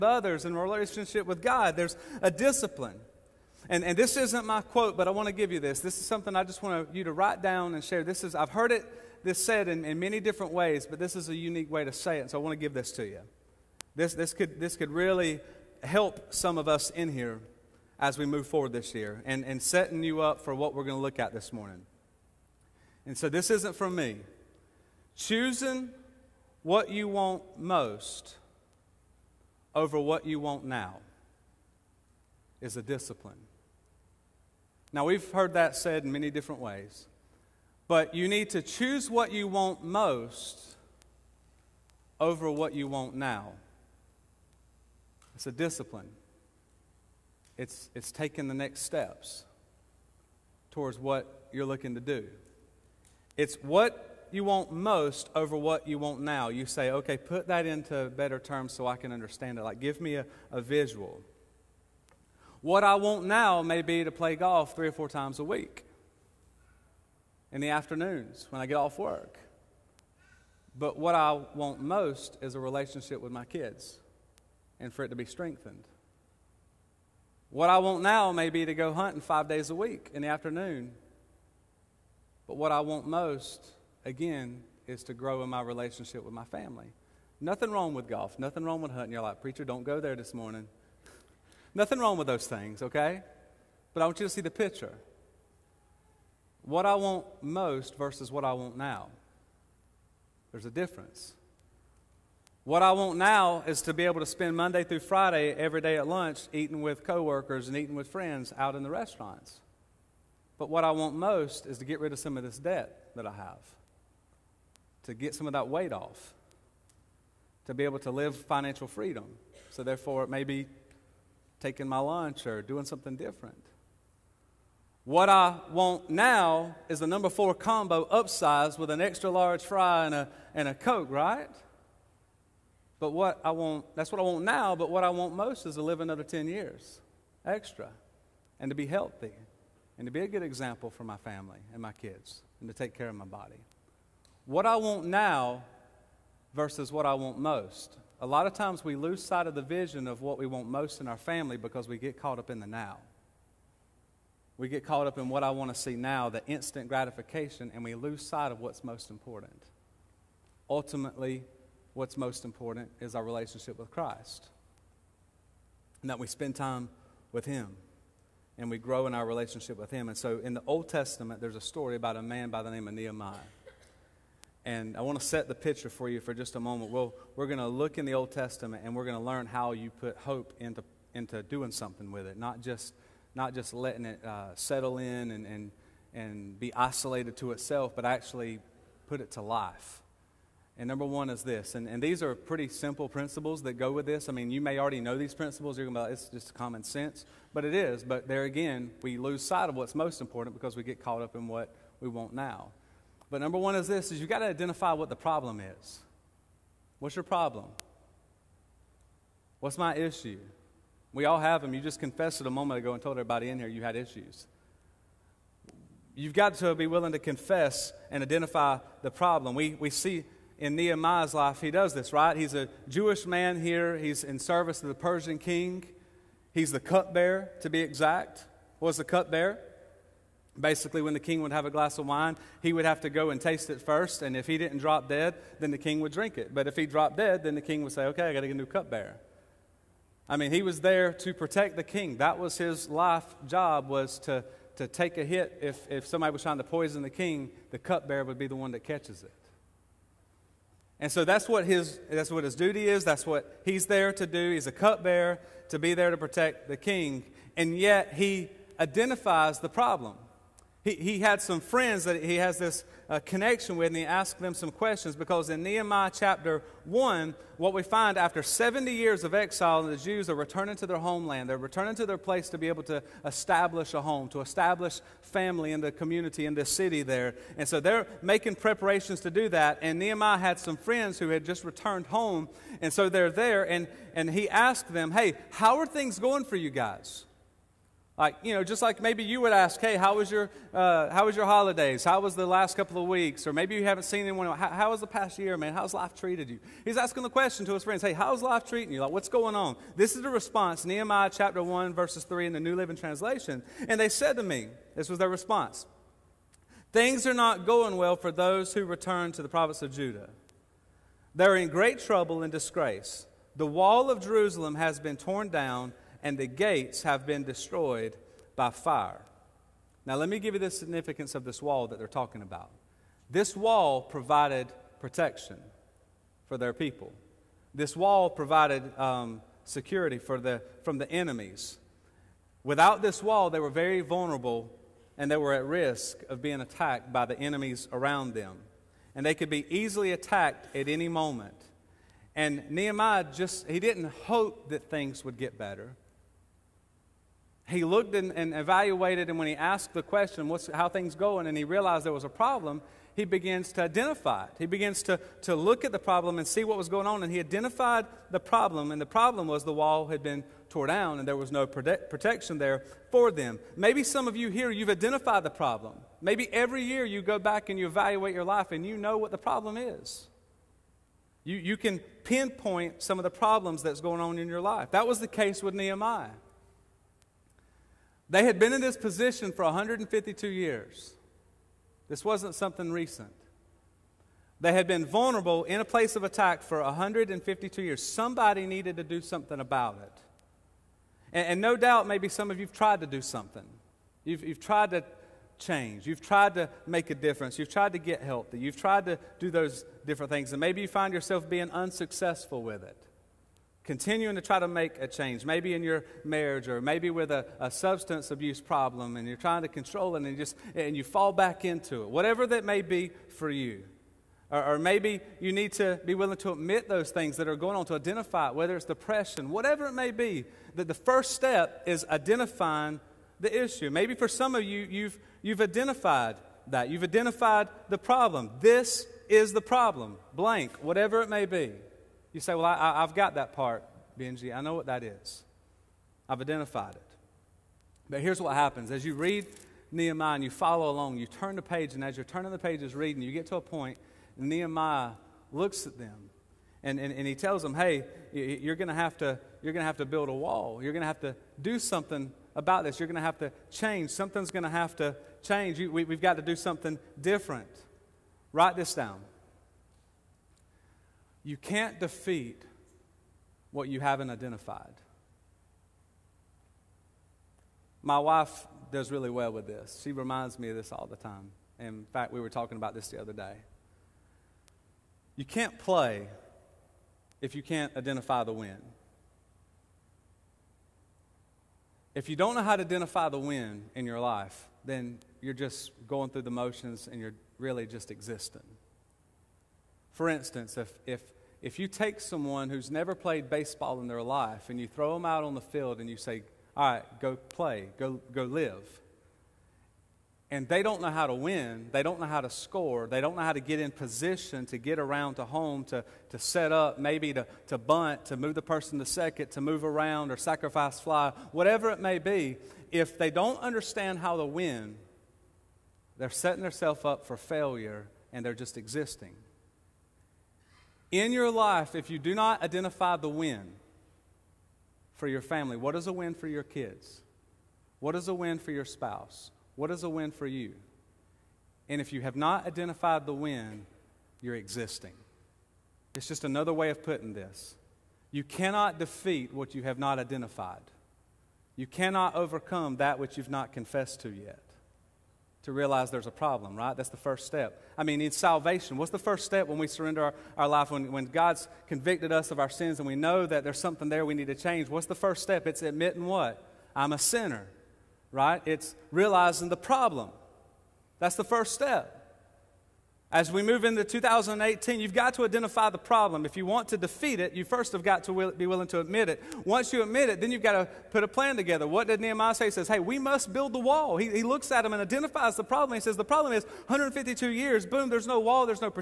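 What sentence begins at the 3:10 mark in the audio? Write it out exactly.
And number one is this, and, and these are pretty simple principles that go with this.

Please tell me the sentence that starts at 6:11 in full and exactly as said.
You, you can pinpoint some of the problems that's going on in your life.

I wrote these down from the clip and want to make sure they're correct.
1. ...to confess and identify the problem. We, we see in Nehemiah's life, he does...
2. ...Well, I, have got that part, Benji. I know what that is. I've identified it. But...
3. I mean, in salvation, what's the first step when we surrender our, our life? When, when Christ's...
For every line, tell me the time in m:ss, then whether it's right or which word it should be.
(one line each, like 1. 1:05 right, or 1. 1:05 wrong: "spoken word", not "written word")
1. 3:37 right
2. 7:12 right
3. 9:07 wrong: "God", not "Christ".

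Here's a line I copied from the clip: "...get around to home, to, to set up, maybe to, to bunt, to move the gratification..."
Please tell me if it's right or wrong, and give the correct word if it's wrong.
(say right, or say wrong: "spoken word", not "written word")
wrong: "person", not "gratification".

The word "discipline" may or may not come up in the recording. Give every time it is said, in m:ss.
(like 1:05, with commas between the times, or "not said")
0:02, 0:32, 0:45.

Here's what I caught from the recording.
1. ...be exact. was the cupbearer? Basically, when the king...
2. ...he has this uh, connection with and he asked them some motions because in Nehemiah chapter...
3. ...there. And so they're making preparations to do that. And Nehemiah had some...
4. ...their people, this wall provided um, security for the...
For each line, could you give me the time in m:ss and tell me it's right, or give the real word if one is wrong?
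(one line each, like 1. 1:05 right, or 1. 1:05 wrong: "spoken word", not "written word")
1. 3:47 right
2. 4:22 wrong: "questions", not "motions"
3. 4:37 right
4. 5:26 right.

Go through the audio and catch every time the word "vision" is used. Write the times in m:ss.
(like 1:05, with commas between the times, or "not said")
2:29.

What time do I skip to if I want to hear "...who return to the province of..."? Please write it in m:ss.
5:08.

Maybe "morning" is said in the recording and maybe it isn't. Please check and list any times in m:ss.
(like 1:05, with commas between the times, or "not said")
0:21, 1:30.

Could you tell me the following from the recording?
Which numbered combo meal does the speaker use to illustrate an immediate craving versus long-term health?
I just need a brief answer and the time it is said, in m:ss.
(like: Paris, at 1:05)
Number 4, at 2:07.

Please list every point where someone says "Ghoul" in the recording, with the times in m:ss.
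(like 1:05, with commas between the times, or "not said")
not said.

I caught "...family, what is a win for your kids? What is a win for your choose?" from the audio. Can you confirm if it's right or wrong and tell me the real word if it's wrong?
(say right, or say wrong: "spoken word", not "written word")
wrong: "spouse", not "choose".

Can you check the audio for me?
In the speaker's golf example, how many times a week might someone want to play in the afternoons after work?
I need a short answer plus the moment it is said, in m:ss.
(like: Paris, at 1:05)
3 or 4, at 1:04.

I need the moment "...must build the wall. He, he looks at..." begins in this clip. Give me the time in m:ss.
9:33.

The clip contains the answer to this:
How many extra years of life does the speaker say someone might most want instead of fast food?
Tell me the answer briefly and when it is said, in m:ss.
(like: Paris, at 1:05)
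10, at 2:16.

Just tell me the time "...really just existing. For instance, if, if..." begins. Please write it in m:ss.
8:07.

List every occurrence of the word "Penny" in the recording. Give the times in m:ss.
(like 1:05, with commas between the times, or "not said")
not said.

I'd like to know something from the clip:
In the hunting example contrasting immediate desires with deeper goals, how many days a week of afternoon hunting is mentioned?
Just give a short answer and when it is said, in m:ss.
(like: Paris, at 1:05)
5, at 1:19.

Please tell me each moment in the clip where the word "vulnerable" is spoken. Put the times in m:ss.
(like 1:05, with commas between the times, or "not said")
5:33, 6:25.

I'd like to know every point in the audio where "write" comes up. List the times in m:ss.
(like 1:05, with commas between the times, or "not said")
0:07, 7:38.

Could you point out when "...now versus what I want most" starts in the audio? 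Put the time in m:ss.
2:25.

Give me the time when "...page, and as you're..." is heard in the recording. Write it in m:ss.
7:21.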